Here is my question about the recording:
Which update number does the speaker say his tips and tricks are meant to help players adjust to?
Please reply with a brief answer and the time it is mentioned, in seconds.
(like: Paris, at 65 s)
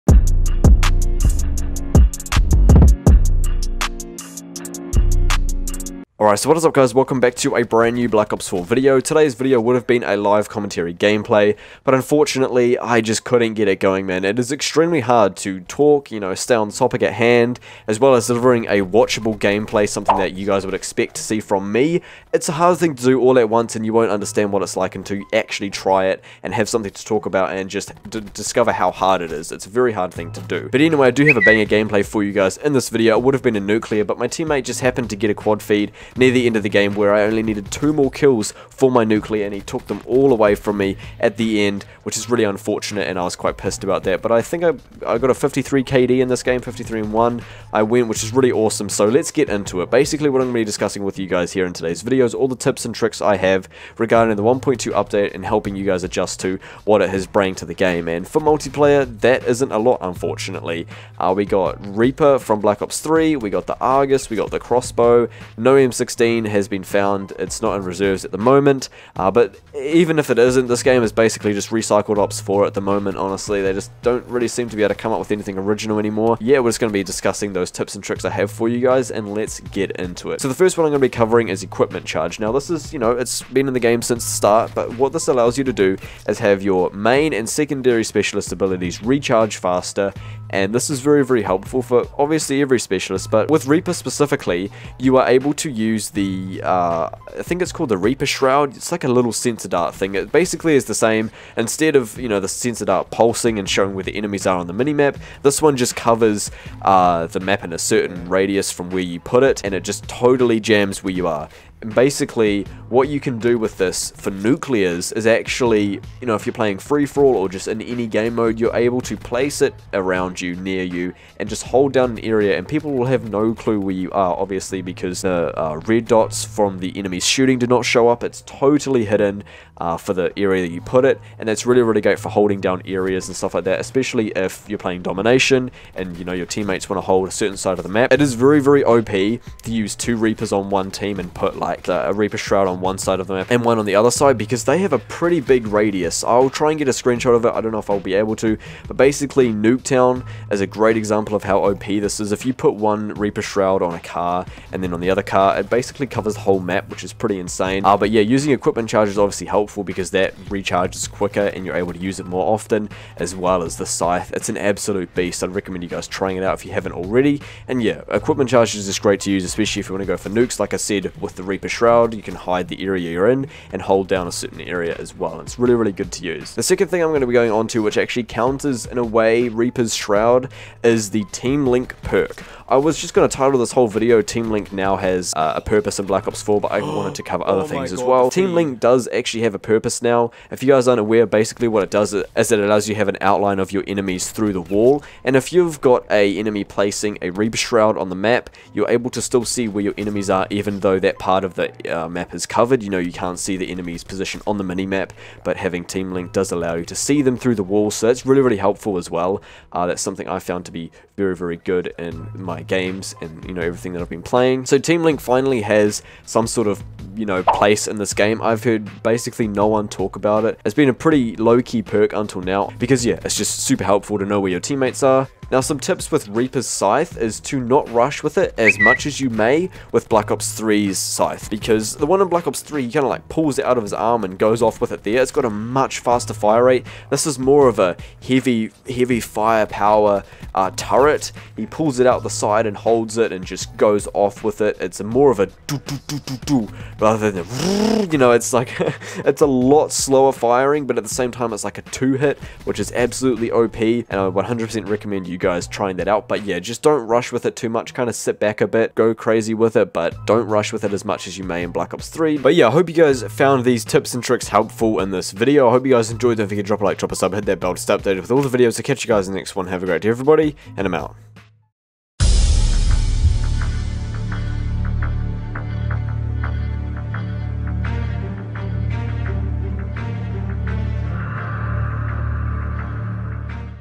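1.2, at 54 s.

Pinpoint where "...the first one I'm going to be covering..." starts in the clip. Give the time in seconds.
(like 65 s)
80 s.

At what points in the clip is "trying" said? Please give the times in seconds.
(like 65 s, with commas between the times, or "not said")
166 s, 255 s.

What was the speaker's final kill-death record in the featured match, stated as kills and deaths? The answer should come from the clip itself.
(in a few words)
53 and 1.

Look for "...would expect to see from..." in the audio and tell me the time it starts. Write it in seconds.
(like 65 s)
20 s.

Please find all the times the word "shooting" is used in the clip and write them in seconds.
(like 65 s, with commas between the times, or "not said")
127 s.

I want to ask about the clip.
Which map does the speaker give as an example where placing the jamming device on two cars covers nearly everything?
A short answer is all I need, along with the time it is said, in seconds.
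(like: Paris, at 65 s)
Nuketown, at 149 s.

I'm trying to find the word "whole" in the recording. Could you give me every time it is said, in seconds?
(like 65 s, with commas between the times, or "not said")
156 s, 183 s.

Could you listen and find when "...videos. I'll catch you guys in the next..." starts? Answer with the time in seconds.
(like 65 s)
268 s.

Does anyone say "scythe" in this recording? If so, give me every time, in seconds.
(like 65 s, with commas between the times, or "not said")
163 s, 226 s, 230 s.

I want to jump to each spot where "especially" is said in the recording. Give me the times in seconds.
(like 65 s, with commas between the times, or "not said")
133 s, 169 s.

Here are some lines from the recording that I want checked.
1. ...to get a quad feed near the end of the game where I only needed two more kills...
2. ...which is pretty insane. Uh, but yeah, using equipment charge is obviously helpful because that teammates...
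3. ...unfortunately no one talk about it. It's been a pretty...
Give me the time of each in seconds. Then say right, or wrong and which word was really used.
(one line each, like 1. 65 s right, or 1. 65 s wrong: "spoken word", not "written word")
1. 35 s right
2. 156 s wrong: "recharges", not "teammates"
3. 219 s wrong: "basically", not "unfortunately".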